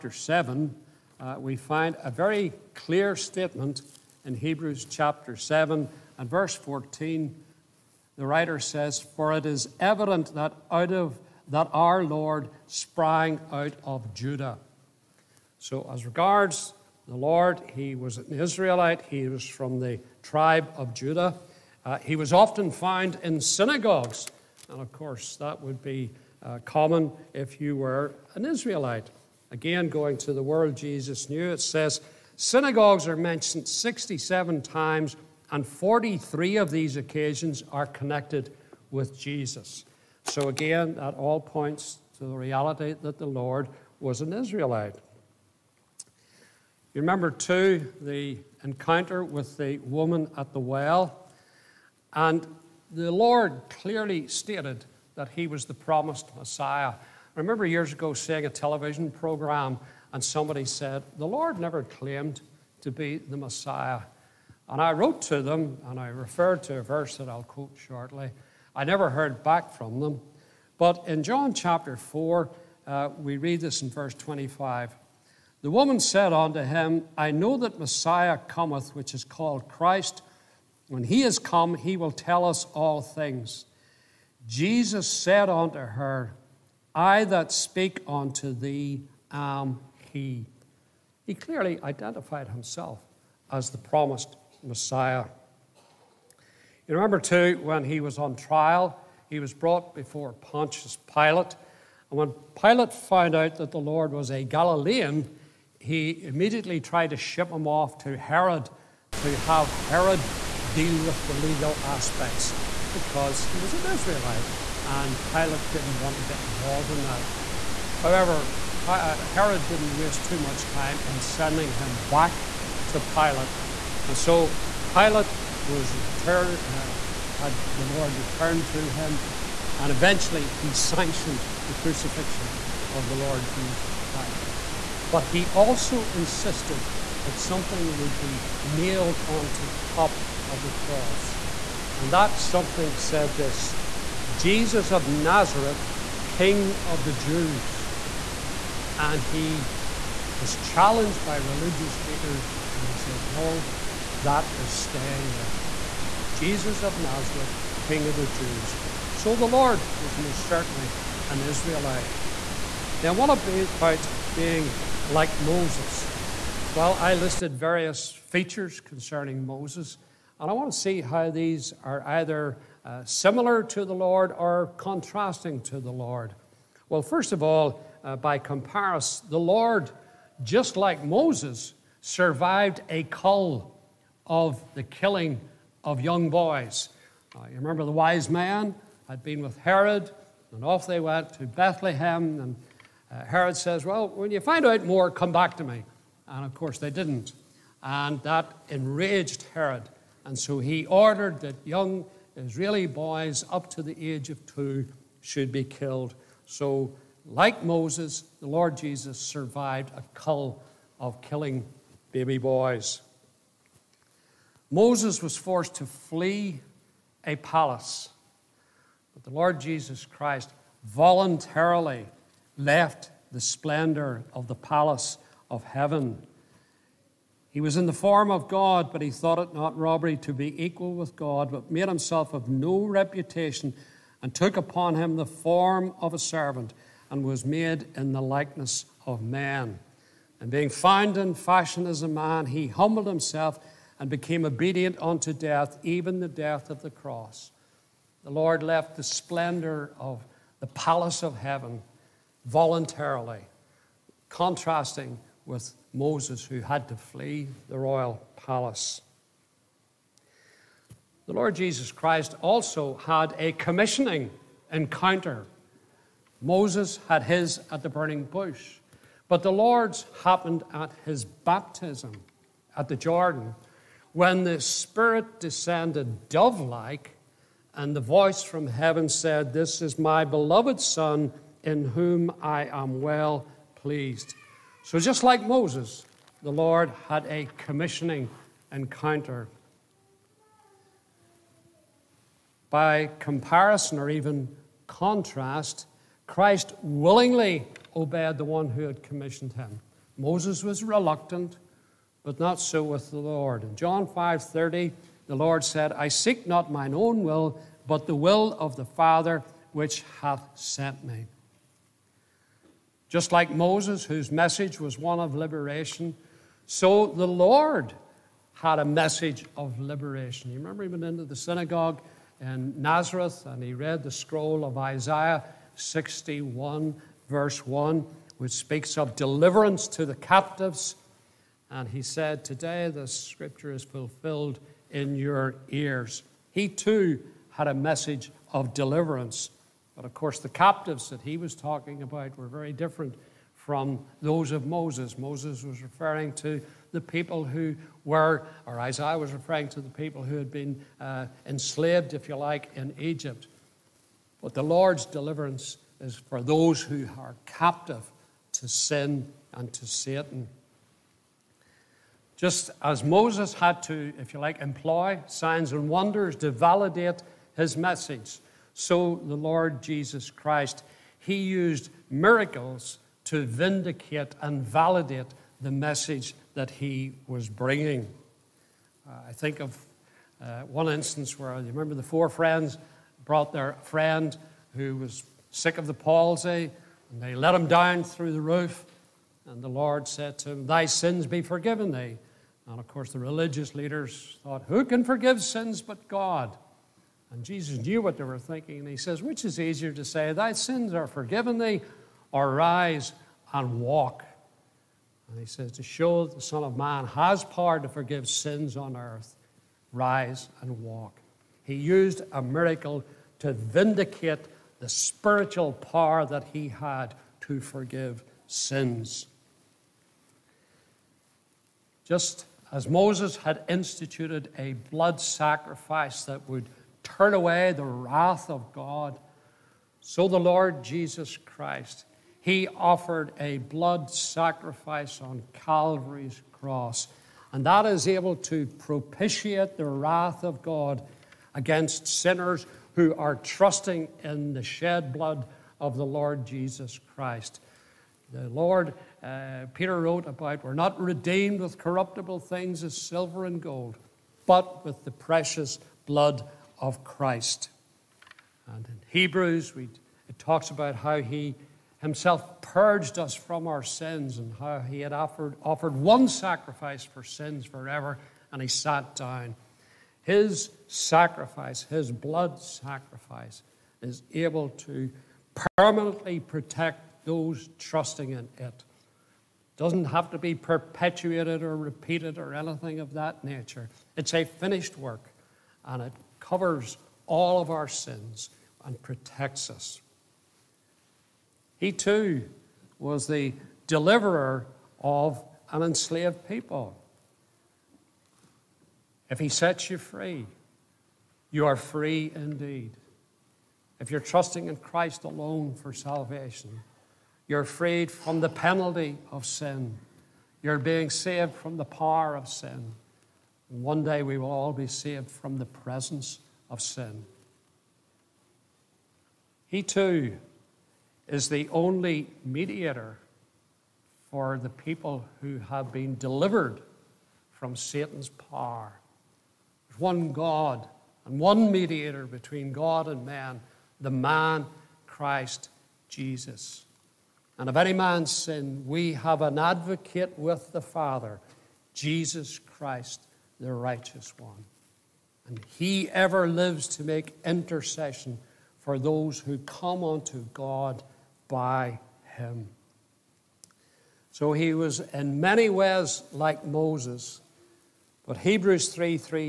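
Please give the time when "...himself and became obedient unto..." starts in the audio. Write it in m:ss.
4:03.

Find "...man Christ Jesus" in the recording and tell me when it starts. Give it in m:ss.
8:54.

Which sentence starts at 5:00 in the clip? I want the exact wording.
Moses was reluctant, but not so with the Lord.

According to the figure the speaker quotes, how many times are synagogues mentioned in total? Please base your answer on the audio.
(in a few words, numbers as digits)
67.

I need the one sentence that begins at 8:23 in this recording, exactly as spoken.
If you're trusting in Christ alone for salvation, you're freed from the penalty of sin.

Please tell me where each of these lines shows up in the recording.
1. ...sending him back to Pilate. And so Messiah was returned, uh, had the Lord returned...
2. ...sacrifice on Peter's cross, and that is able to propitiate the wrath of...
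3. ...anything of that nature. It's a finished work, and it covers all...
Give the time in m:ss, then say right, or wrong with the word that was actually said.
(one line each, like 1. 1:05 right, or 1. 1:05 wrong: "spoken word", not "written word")
1. 2:01 wrong: "Pilate", not "Messiah"
2. 7:14 wrong: "Calvary", not "Peter"
3. 8:02 right.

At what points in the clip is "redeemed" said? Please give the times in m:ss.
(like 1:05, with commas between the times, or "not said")
7:30.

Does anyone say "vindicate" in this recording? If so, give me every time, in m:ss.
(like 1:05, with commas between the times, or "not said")
6:13, 6:53.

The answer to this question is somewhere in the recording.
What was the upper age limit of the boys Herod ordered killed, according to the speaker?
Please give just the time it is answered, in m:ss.
3:24.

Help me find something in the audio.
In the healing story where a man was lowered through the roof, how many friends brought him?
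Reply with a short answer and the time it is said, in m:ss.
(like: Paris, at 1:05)
4, at 6:22.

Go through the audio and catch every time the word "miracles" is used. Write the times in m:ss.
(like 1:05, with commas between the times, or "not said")
6:12, 6:52.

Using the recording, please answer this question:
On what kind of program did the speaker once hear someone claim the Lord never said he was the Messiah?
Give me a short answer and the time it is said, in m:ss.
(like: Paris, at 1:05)
Television program, at 0:58.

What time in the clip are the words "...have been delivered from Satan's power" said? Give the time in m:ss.
8:45.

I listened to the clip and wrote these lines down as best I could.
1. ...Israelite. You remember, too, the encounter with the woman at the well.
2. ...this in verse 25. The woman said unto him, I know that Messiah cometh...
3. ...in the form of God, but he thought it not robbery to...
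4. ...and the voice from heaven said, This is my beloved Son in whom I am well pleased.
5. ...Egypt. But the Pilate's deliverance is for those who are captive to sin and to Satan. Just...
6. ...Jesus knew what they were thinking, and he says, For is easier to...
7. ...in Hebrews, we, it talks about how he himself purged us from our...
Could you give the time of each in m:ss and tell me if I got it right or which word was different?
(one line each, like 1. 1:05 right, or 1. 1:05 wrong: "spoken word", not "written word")
1. 0:44 right
2. 1:13 right
3. 3:47 right
4. 4:37 right
5. 5:52 wrong: "Lord", not "Pilate"
6. 6:37 wrong: "Which", not "For"
7. 7:38 right.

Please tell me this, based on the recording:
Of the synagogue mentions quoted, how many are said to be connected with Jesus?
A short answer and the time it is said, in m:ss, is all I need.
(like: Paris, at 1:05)
43, at 0:35.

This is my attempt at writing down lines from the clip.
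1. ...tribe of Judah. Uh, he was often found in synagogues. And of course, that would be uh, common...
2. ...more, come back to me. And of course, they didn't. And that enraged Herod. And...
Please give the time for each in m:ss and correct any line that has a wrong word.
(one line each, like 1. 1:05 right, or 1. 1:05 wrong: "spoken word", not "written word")
1. 0:20 right
2. 3:14 right.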